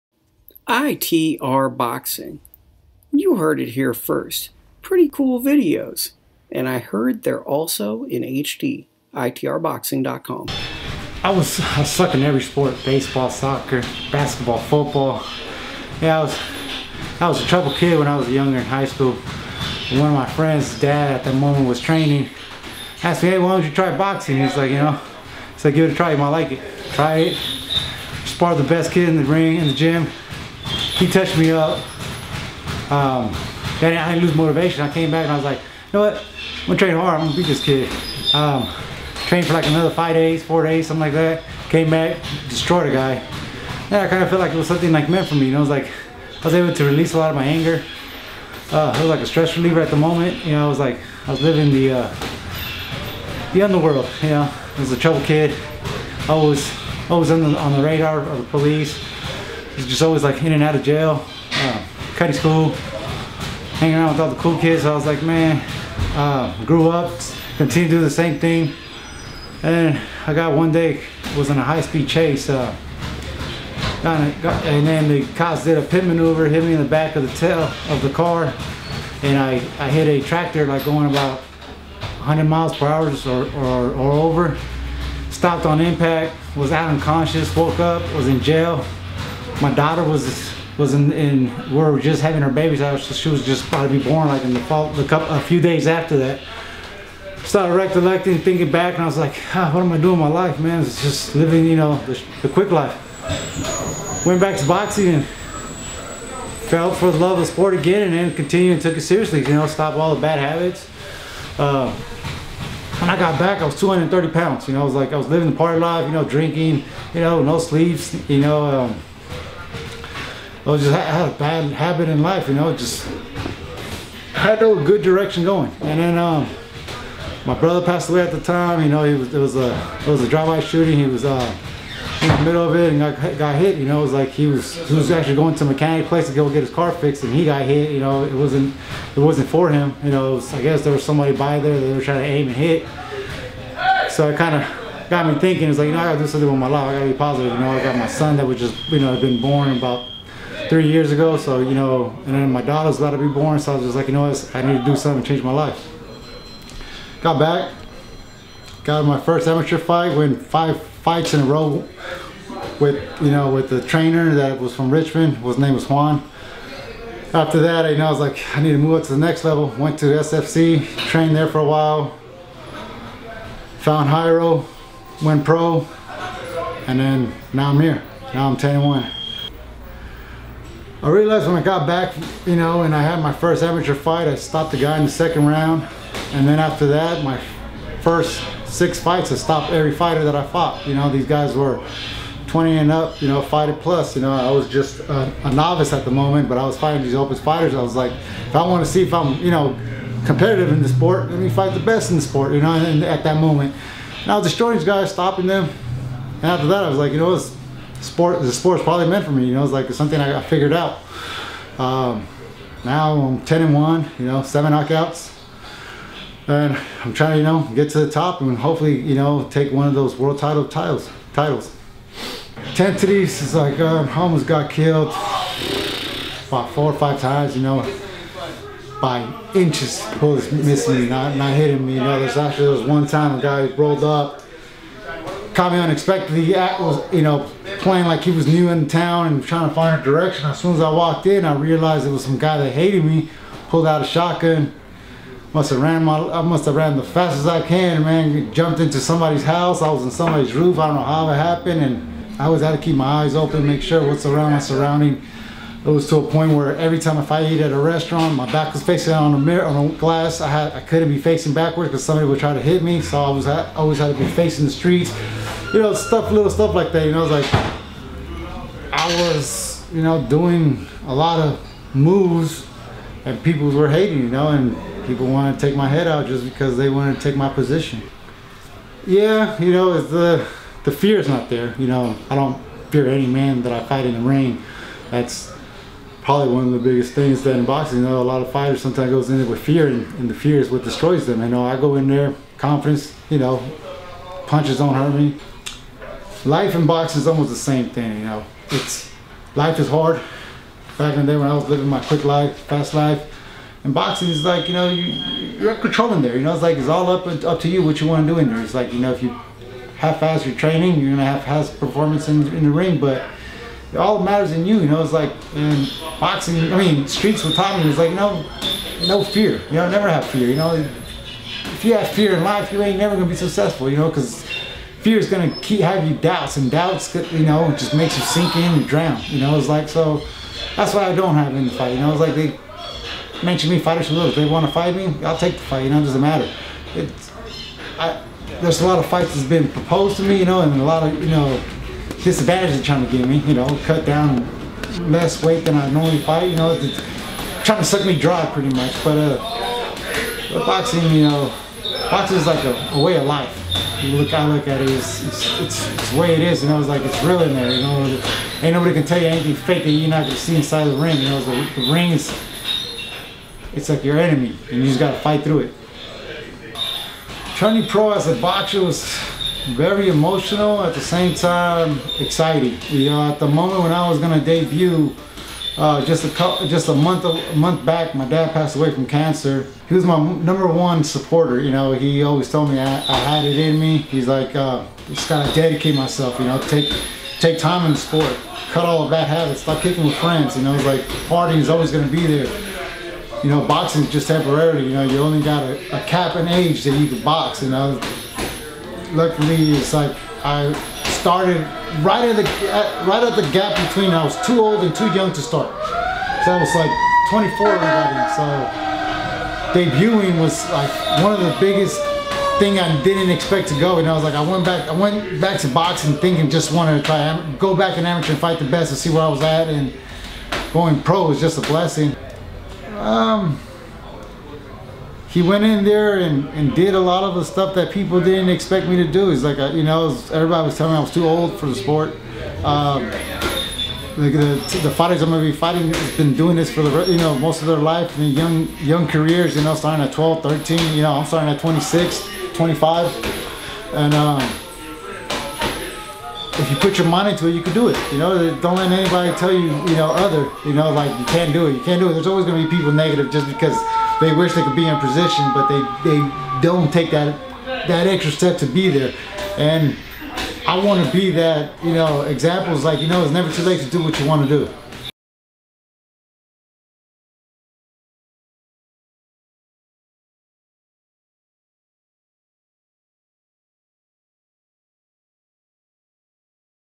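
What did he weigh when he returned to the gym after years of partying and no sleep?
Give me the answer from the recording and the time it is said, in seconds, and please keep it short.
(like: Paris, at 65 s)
230 pounds, at 113 s.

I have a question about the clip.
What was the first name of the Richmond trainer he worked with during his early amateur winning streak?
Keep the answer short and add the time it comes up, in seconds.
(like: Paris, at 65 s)
Juan, at 165 s.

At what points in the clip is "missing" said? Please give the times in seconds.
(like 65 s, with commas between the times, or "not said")
230 s.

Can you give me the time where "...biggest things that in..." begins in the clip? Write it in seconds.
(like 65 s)
286 s.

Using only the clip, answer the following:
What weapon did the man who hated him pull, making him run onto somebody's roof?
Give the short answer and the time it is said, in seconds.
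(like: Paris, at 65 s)
shotgun, at 244 s.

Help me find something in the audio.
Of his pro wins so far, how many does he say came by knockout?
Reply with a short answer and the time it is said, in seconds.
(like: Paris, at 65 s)
7, at 214 s.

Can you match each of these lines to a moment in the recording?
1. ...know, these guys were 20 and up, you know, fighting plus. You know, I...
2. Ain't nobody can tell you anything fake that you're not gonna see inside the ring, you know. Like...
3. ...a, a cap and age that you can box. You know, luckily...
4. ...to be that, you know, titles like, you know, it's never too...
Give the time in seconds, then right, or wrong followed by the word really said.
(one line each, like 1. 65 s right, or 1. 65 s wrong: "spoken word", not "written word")
1. 190 s right
2. 358 s right
3. 395 s right
4. 461 s wrong: "examples", not "titles".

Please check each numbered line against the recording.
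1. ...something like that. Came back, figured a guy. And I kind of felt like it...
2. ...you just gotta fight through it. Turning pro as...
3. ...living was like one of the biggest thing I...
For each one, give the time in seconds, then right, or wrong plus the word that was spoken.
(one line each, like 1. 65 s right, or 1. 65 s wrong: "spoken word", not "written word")
1. 40 s wrong: "destroyed", not "figured"
2. 364 s right
3. 409 s wrong: "debuting", not "living".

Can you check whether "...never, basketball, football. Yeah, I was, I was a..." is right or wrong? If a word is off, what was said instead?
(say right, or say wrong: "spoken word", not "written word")
wrong: "soccer", not "never".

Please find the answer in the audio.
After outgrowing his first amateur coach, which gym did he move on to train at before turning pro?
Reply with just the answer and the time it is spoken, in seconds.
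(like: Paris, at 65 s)
SFC, at 170 s.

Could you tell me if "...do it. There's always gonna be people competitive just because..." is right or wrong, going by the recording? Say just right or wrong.
wrong.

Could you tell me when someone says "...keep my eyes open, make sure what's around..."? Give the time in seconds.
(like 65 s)
252 s.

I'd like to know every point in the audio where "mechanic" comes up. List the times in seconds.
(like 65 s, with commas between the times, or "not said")
135 s.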